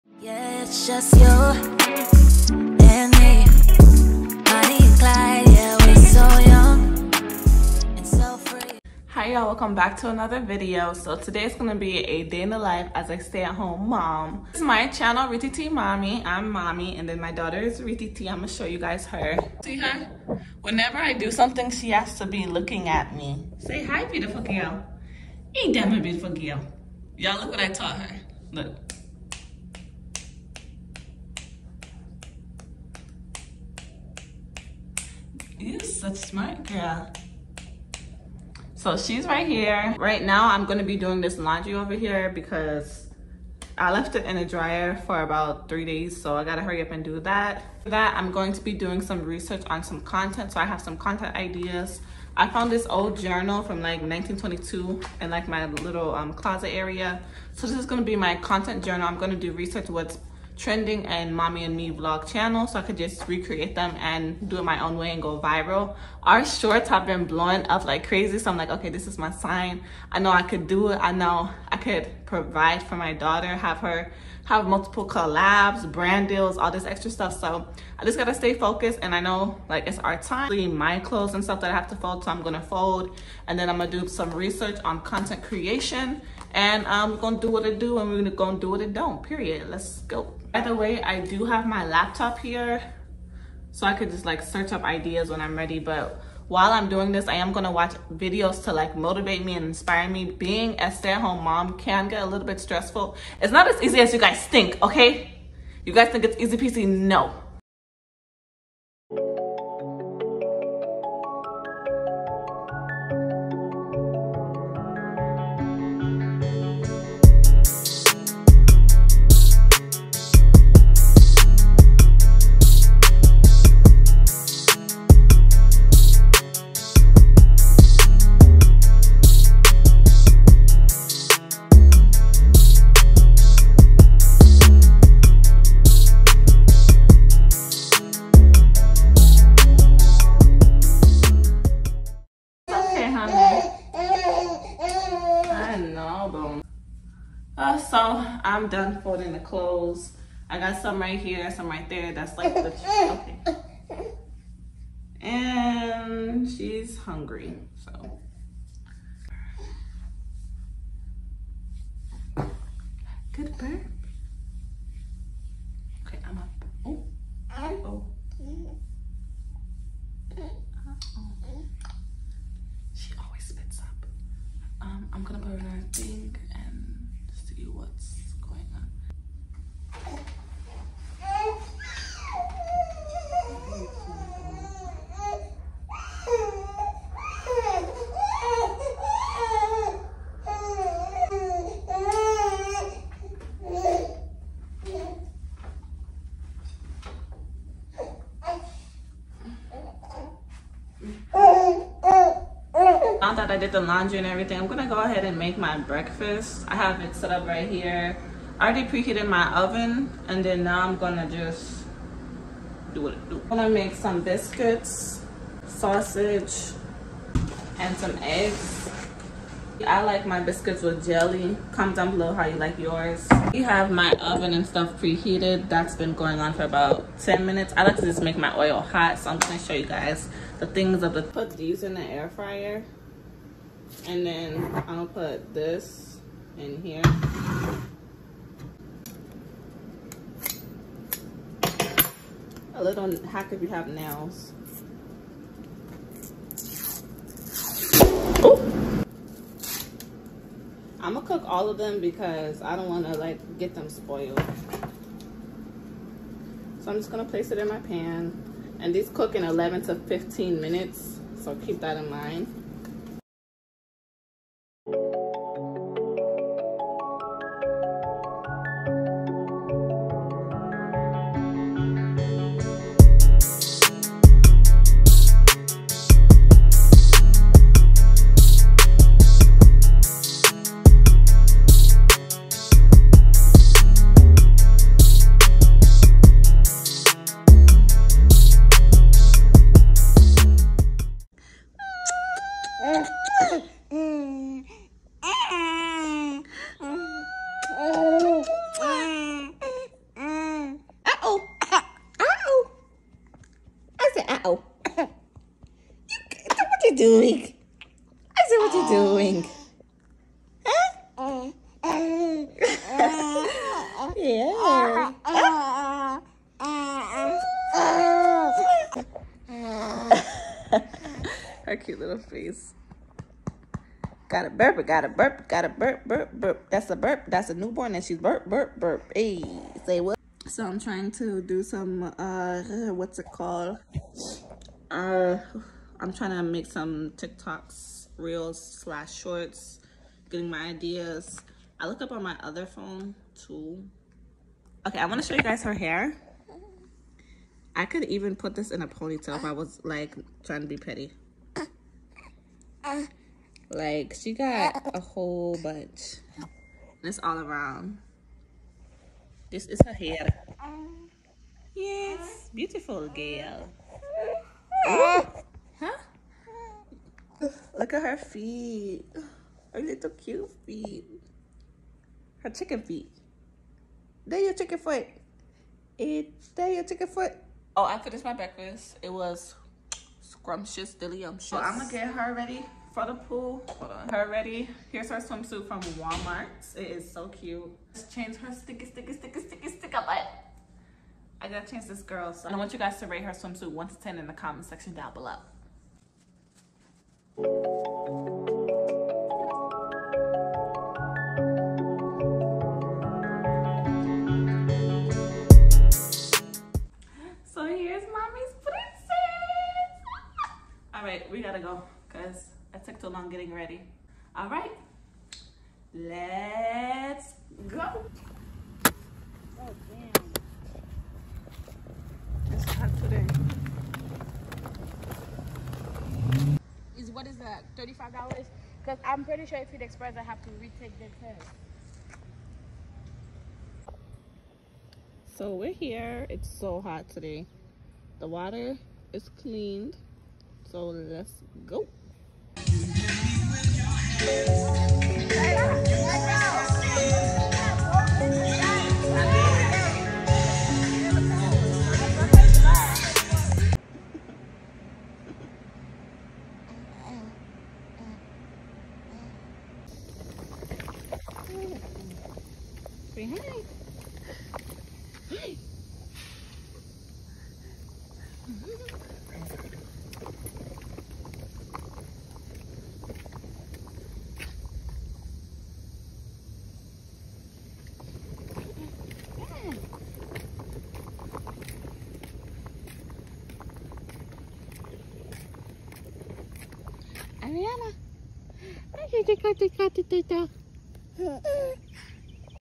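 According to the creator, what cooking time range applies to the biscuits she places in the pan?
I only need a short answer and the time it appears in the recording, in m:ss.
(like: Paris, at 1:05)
11 to 15 minutes, at 4:19.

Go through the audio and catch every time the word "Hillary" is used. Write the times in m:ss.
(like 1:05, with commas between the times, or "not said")
not said.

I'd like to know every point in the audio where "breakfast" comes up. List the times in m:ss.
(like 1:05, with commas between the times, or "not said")
3:25, 6:18.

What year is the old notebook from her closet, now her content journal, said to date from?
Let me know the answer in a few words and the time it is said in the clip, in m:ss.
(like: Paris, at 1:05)
1922, at 0:54.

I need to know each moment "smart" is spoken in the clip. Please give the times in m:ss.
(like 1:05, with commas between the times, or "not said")
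0:36.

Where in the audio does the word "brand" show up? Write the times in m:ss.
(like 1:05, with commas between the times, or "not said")
1:15.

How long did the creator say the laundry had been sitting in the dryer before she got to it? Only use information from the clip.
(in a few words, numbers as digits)
3 days.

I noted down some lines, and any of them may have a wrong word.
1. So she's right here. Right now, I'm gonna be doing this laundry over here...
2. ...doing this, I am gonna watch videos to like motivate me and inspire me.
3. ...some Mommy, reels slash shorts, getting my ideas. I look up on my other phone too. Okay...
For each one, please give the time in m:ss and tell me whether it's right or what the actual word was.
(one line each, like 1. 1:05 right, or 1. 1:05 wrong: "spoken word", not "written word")
1. 0:38 right
2. 1:36 right
3. 5:36 wrong: "TikToks", not "Mommy".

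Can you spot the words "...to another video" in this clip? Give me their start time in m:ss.
0:09.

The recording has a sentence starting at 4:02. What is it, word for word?
A little hack if you have nails.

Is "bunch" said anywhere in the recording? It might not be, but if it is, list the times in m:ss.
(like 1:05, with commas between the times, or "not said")
5:55.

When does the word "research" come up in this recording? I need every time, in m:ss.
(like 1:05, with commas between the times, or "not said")
0:49, 0:59, 1:24.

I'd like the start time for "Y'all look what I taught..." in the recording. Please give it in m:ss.
0:27.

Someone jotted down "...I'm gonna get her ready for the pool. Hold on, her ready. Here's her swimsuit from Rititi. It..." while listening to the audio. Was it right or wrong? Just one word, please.
wrong.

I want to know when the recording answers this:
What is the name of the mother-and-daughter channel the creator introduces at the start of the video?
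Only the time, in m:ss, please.
0:15.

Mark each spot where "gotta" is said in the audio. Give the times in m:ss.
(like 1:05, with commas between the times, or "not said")
0:46, 1:18, 6:31.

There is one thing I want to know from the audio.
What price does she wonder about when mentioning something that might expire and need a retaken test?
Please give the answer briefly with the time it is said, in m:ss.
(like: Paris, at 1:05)
$35, at 7:07.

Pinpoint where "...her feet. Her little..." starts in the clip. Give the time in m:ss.
6:08.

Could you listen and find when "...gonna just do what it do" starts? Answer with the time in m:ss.
3:30.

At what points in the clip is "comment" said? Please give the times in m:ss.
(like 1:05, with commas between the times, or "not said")
3:41, 6:34.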